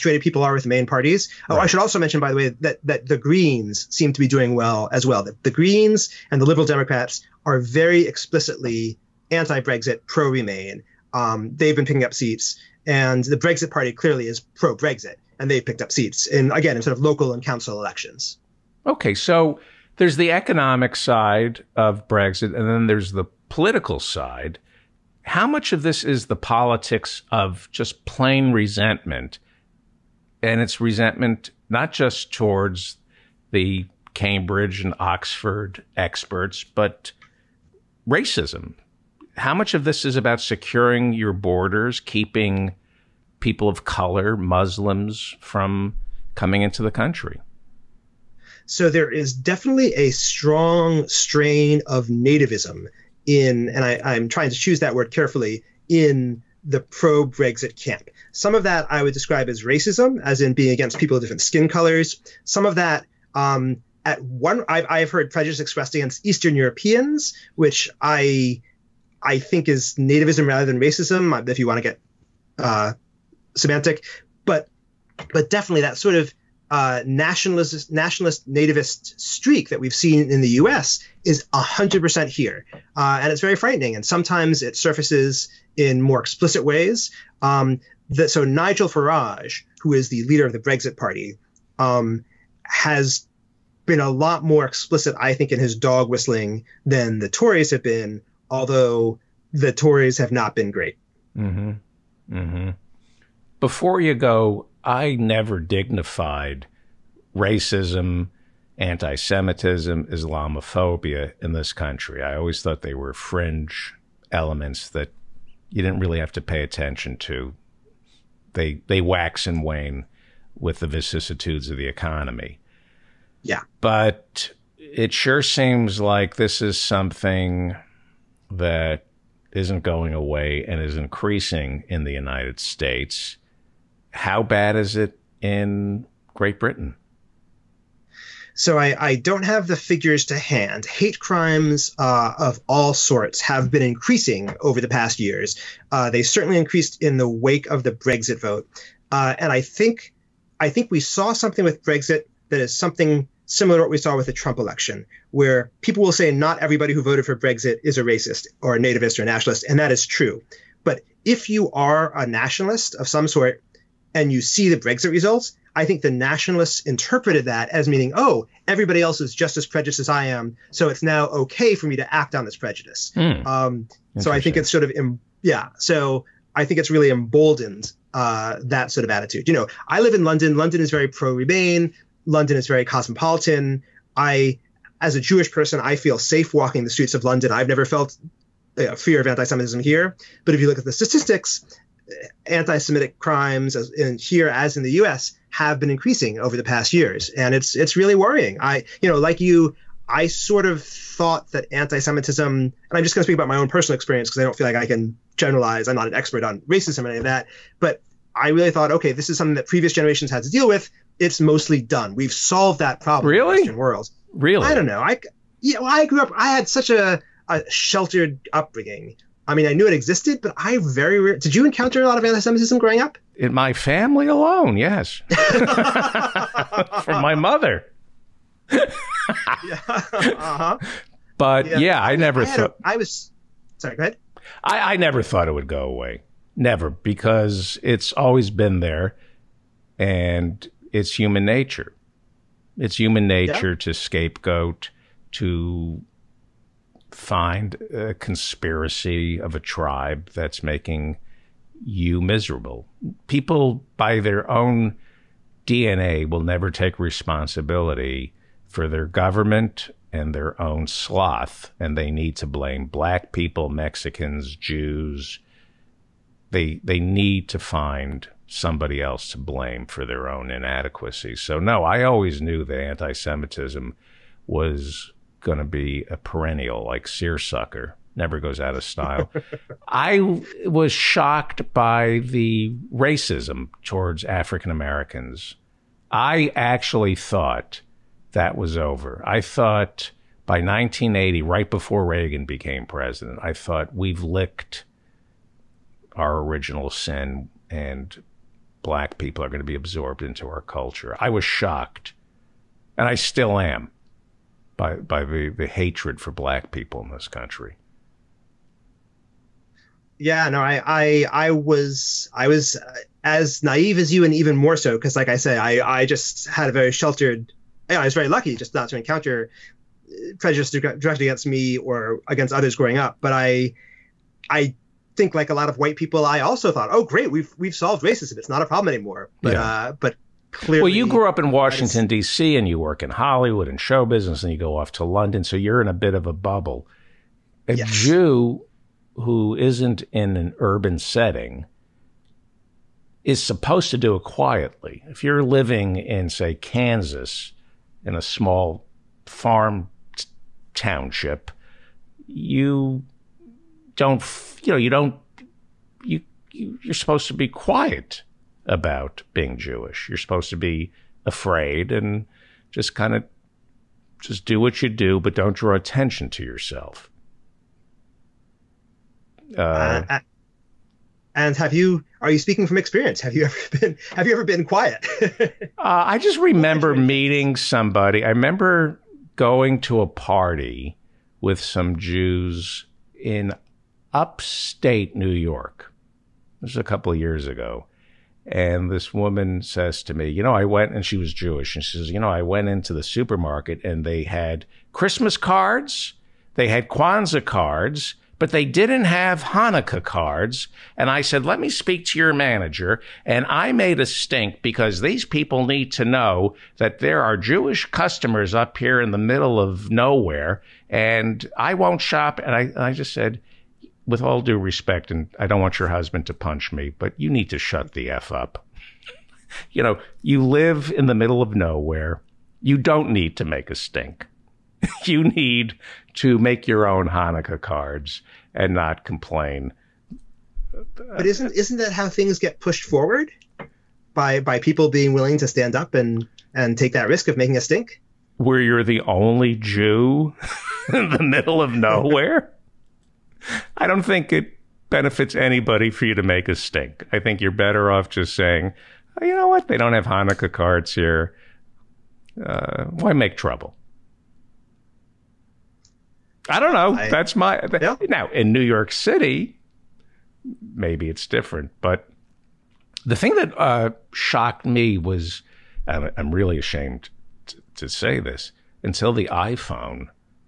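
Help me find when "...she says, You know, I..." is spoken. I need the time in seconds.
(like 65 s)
391 s.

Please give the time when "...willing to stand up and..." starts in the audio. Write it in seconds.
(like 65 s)
435 s.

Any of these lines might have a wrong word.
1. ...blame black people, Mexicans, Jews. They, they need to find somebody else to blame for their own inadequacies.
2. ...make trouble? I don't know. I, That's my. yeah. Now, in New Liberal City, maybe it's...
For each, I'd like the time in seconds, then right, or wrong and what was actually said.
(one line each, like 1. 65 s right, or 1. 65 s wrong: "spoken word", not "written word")
1. 262 s right
2. 453 s wrong: "York", not "Liberal".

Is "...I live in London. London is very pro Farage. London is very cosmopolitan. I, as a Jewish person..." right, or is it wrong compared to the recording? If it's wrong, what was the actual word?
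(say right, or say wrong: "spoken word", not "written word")
wrong: "Remain", not "Farage".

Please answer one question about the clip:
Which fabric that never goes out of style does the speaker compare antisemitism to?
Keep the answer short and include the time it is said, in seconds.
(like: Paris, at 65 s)
Seersucker, at 277 s.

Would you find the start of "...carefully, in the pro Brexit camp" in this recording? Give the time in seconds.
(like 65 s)
55 s.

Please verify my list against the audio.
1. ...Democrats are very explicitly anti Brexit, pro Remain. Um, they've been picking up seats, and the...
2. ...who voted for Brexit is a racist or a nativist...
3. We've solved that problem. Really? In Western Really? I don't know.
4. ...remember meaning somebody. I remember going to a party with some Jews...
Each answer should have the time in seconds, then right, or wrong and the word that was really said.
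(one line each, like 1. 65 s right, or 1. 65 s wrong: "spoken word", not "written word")
1. 6 s right
2. 156 s right
3. 212 s right
4. 376 s wrong: "meeting", not "meaning".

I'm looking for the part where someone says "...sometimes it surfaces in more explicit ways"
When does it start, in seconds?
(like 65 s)
84 s.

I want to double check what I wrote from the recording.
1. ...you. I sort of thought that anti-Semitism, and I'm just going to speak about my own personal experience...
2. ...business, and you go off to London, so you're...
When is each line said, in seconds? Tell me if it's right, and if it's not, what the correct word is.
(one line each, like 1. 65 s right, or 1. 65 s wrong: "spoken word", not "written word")
1. 199 s right
2. 334 s right.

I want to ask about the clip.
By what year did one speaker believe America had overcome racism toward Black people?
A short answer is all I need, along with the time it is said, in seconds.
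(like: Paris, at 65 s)
1980, at 290 s.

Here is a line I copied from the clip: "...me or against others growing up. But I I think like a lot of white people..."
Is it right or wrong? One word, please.
right.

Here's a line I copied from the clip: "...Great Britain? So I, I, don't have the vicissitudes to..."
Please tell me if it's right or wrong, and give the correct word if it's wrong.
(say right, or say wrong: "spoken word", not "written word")
wrong: "figures", not "vicissitudes".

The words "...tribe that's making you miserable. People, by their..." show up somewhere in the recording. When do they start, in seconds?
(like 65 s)
249 s.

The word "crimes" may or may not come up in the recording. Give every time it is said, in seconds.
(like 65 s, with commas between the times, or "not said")
141 s, 193 s.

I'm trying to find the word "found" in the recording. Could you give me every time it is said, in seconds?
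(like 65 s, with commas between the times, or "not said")
not said.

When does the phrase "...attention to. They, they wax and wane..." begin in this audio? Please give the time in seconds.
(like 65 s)
116 s.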